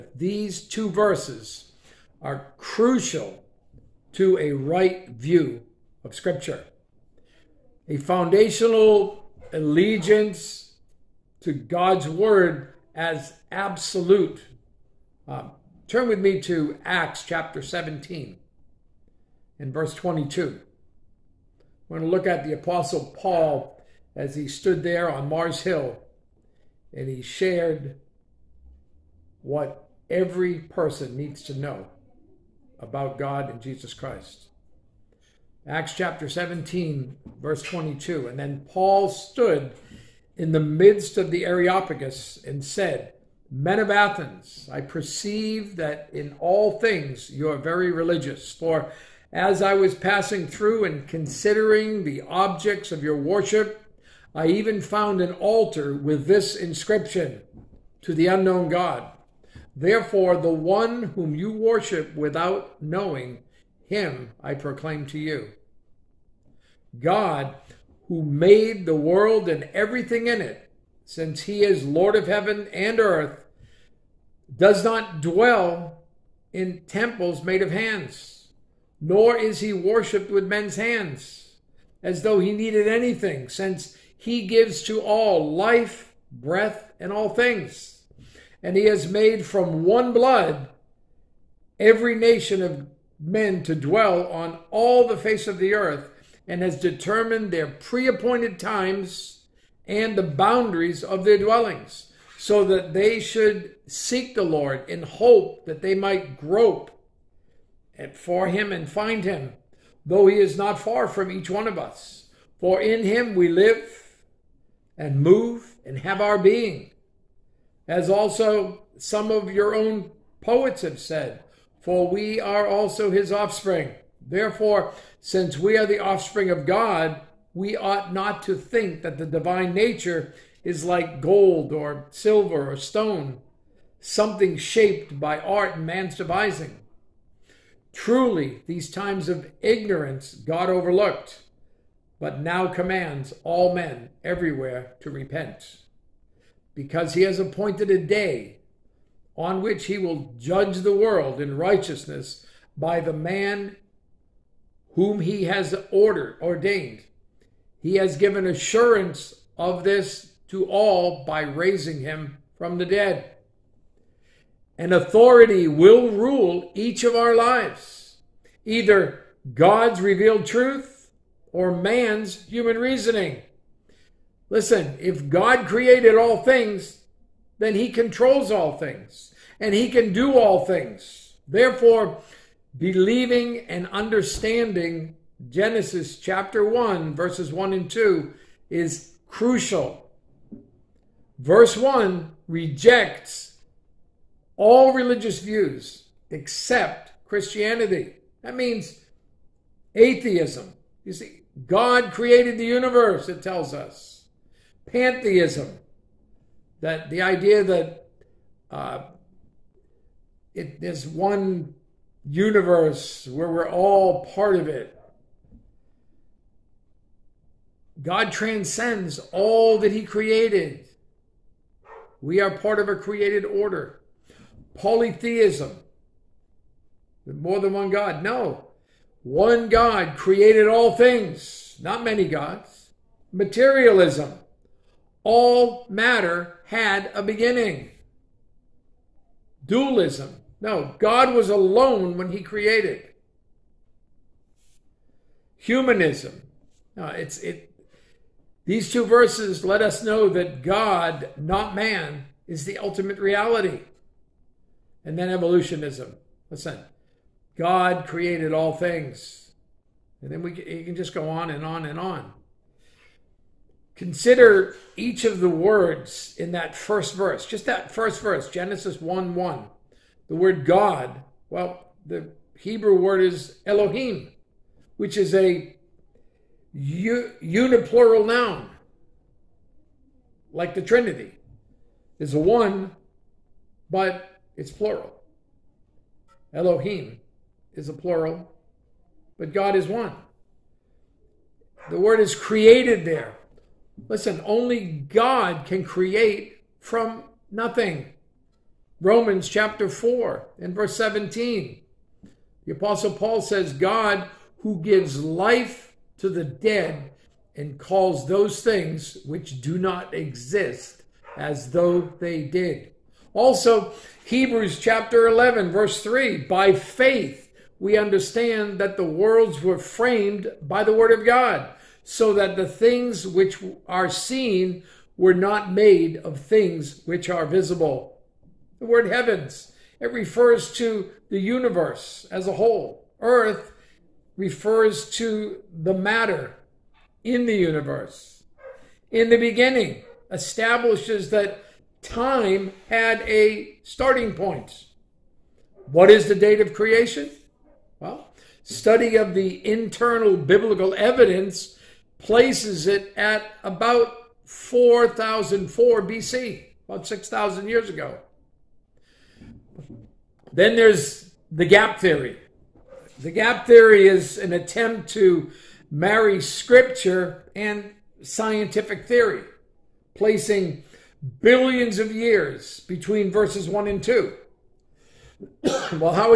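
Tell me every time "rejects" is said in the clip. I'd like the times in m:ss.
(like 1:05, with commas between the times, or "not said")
3:12.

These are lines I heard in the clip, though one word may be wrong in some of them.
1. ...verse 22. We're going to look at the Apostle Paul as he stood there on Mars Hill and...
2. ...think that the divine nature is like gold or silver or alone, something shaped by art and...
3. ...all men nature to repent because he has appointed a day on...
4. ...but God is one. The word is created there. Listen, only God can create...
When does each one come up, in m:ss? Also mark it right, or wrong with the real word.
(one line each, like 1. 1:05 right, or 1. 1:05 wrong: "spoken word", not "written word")
1. 0:19 right
2. 2:08 wrong: "stone", not "alone"
3. 2:23 wrong: "everywhere", not "nature"
4. 4:49 right.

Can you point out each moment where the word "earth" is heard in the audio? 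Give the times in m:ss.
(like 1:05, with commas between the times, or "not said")
1:13, 1:35, 5:33.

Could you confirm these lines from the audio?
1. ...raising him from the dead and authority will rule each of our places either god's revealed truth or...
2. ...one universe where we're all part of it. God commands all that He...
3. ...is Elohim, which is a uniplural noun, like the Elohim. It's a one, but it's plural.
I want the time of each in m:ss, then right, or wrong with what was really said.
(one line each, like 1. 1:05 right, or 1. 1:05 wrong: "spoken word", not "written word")
1. 2:41 wrong: "lives", not "places"
2. 3:31 wrong: "transcends", not "commands"
3. 4:33 wrong: "Trinity", not "Elohim".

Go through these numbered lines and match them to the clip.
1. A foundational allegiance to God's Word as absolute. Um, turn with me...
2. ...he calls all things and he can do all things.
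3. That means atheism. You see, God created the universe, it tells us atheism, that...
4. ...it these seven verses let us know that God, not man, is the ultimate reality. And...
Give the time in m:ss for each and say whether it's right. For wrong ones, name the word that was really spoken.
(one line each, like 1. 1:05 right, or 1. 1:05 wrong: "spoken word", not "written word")
1. 0:07 right
2. 2:57 wrong: "controls", not "calls"
3. 3:18 wrong: "pantheism", not "atheism"
4. 4:07 wrong: "two", not "seven".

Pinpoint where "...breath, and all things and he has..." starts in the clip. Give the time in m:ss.
1:26.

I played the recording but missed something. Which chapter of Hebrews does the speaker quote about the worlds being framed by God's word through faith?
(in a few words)
Chapter 11.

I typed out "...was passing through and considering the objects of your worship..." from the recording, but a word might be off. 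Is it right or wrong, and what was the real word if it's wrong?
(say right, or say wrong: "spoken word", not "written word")
right.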